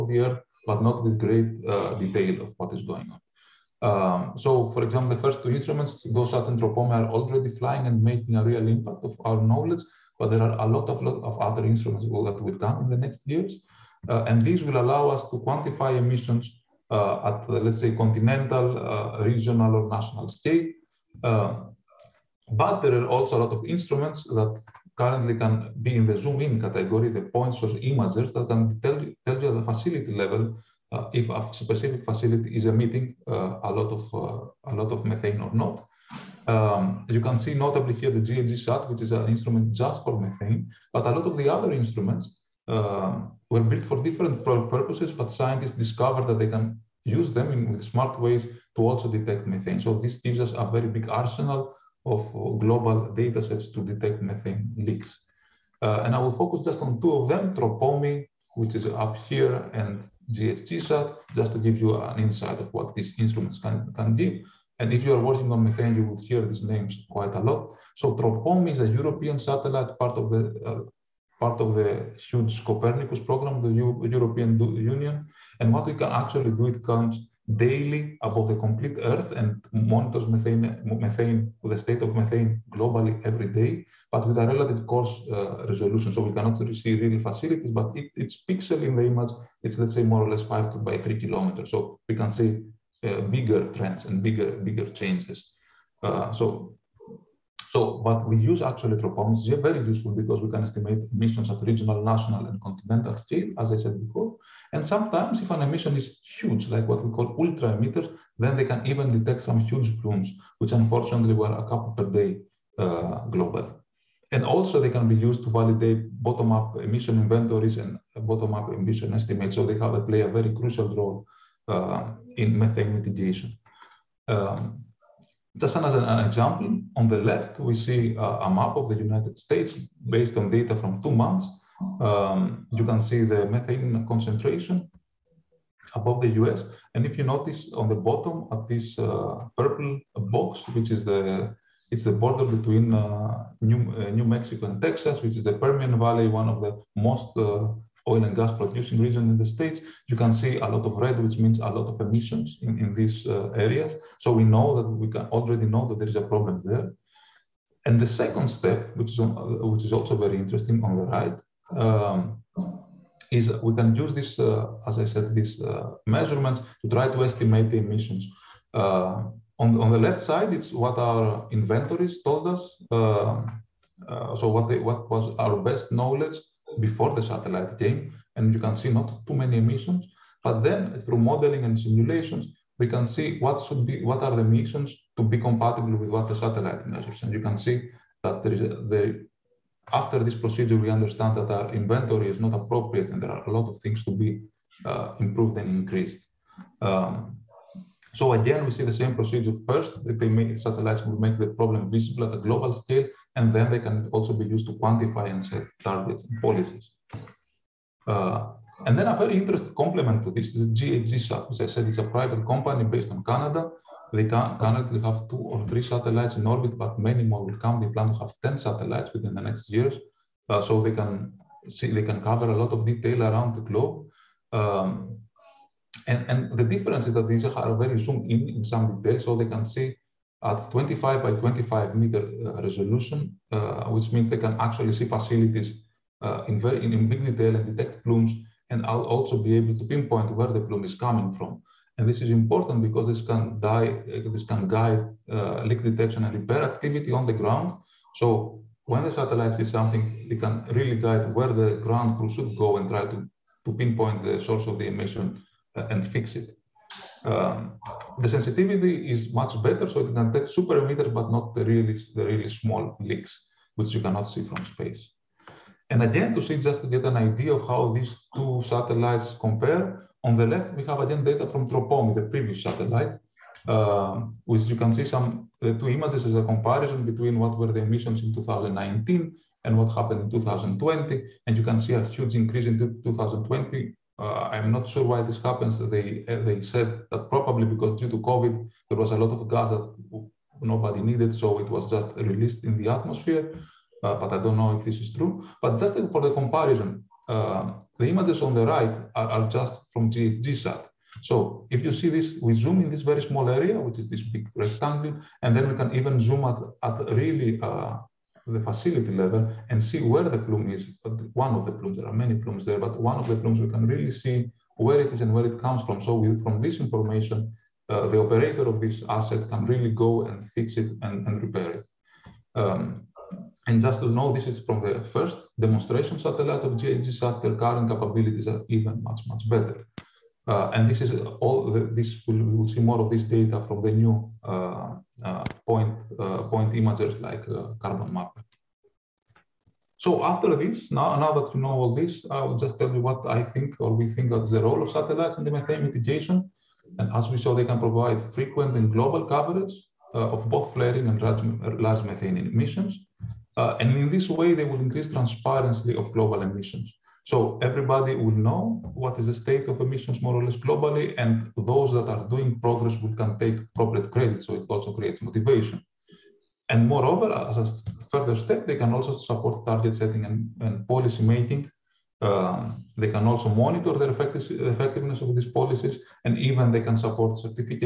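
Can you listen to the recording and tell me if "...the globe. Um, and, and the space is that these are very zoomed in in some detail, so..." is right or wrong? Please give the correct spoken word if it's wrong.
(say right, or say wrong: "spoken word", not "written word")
wrong: "difference", not "space".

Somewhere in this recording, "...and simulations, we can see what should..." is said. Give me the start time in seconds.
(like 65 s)
181 s.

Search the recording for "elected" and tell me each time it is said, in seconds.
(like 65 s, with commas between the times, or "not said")
not said.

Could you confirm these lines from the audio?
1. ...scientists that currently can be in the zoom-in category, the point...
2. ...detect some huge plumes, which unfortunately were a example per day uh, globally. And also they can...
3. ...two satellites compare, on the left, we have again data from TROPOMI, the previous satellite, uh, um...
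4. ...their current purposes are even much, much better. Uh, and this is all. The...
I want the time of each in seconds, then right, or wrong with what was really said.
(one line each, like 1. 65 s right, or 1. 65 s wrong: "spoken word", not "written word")
1. 23 s wrong: "instruments", not "scientists"
2. 109 s wrong: "couple", not "example"
3. 268 s right
4. 327 s wrong: "capabilities", not "purposes".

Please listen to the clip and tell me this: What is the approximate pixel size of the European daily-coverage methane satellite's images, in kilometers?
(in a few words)
5 by 3 kilometers.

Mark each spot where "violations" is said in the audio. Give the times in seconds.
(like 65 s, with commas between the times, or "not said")
not said.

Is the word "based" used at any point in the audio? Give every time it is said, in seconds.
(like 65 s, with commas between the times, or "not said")
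130 s, 212 s.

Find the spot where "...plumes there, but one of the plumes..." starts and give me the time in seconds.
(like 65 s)
312 s.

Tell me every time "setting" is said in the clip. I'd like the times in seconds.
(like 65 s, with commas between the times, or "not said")
369 s.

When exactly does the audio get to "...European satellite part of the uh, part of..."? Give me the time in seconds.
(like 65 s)
68 s.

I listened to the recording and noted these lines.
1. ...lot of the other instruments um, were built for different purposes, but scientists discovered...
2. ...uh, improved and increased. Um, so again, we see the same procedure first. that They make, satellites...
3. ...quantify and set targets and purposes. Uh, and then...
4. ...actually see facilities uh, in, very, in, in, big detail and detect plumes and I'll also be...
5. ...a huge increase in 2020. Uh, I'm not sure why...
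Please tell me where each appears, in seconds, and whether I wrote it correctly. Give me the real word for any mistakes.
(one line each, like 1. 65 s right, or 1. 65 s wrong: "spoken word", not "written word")
1. 41 s right
2. 194 s right
3. 204 s wrong: "policies", not "purposes"
4. 234 s right
5. 281 s right.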